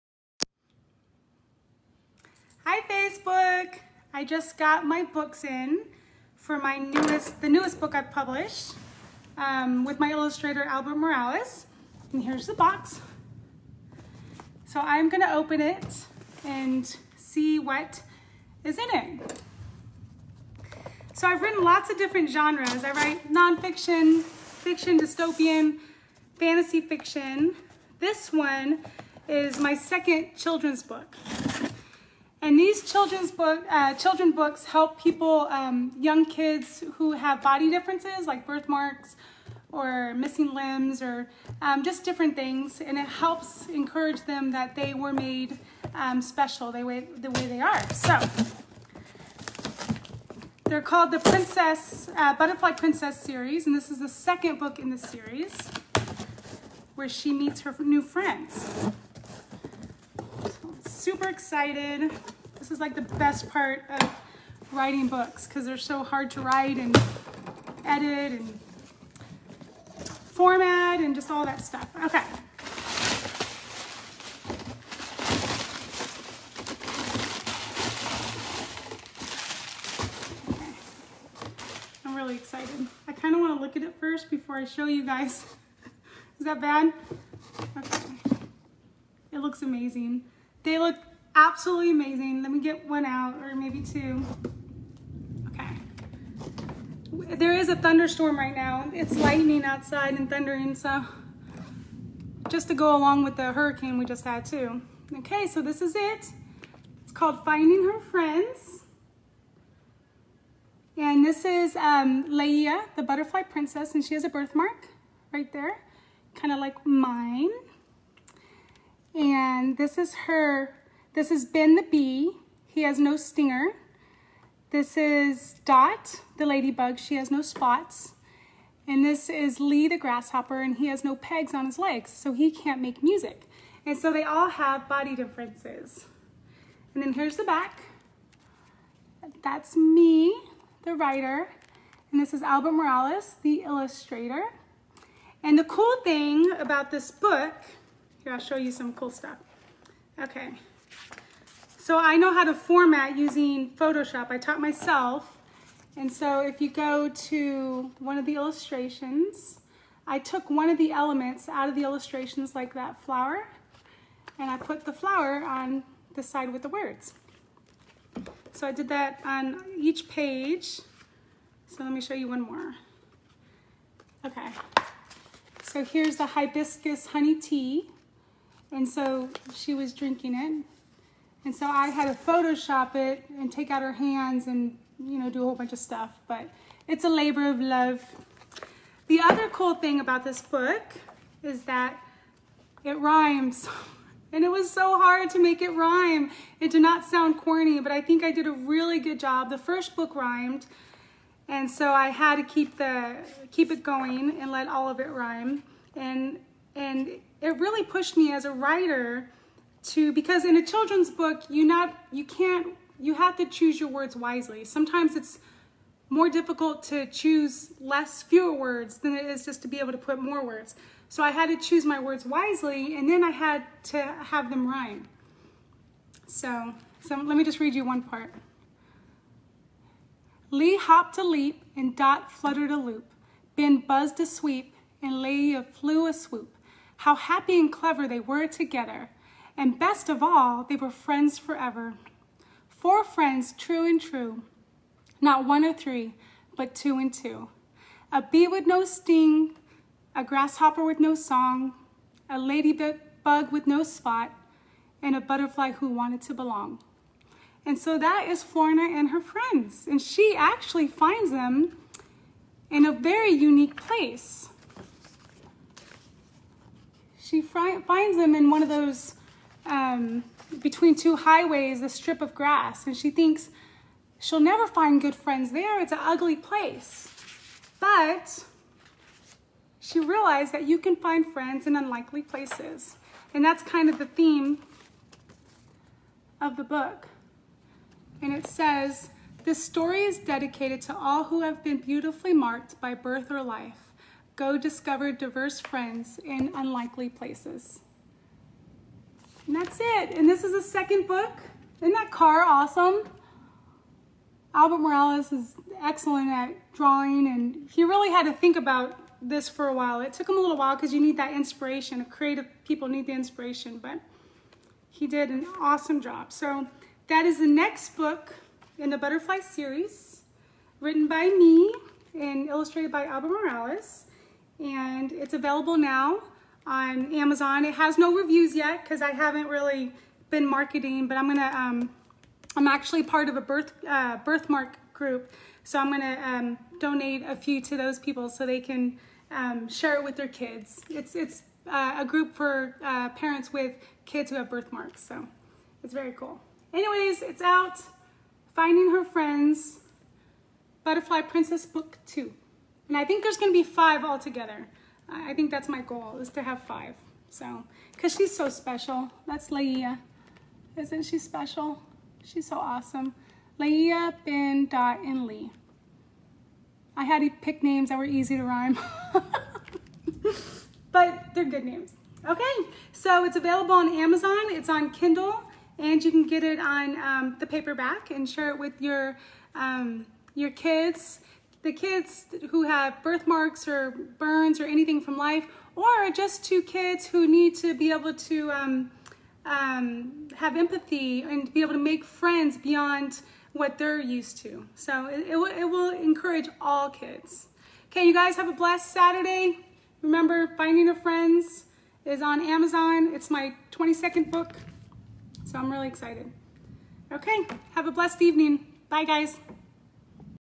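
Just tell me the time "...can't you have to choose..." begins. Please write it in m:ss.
3:32.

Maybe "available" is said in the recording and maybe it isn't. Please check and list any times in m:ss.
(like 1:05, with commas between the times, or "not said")
5:25, 6:13.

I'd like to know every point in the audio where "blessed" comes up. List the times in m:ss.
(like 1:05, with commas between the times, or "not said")
6:38, 6:47.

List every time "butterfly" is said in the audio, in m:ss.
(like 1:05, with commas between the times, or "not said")
0:52, 1:53, 4:15, 5:18, 5:50.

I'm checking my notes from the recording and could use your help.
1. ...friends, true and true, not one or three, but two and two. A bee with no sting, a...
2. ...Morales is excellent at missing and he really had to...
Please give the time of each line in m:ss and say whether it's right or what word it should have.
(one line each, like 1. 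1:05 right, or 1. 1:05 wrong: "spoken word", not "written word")
1. 4:03 right
2. 5:04 wrong: "drawing", not "missing".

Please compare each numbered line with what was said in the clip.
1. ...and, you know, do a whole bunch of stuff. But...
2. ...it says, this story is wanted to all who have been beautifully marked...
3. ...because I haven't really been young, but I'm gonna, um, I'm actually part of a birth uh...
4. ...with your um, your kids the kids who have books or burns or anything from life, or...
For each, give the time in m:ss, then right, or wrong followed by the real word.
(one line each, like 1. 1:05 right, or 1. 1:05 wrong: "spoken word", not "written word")
1. 3:04 right
2. 4:48 wrong: "dedicated", not "wanted"
3. 5:28 wrong: "marketing", not "young"
4. 6:18 wrong: "birthmarks", not "books".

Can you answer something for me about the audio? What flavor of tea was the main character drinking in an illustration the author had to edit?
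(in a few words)
hibiscus honey.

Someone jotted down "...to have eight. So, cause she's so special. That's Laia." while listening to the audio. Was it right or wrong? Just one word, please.
wrong.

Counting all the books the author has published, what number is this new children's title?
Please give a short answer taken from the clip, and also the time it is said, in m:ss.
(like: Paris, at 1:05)
22nd, at 6:43.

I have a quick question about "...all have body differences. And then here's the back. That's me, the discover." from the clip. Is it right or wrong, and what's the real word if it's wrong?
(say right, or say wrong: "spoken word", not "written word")
wrong: "writer", not "discover".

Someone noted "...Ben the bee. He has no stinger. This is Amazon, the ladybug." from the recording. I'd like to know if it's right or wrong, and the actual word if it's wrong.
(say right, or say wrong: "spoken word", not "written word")
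wrong: "Dot", not "Amazon".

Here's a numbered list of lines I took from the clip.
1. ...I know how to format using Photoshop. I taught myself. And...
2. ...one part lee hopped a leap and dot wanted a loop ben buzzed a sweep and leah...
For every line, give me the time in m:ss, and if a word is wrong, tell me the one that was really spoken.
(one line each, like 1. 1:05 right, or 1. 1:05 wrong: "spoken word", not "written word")
1. 2:31 right
2. 3:47 wrong: "fluttered", not "wanted".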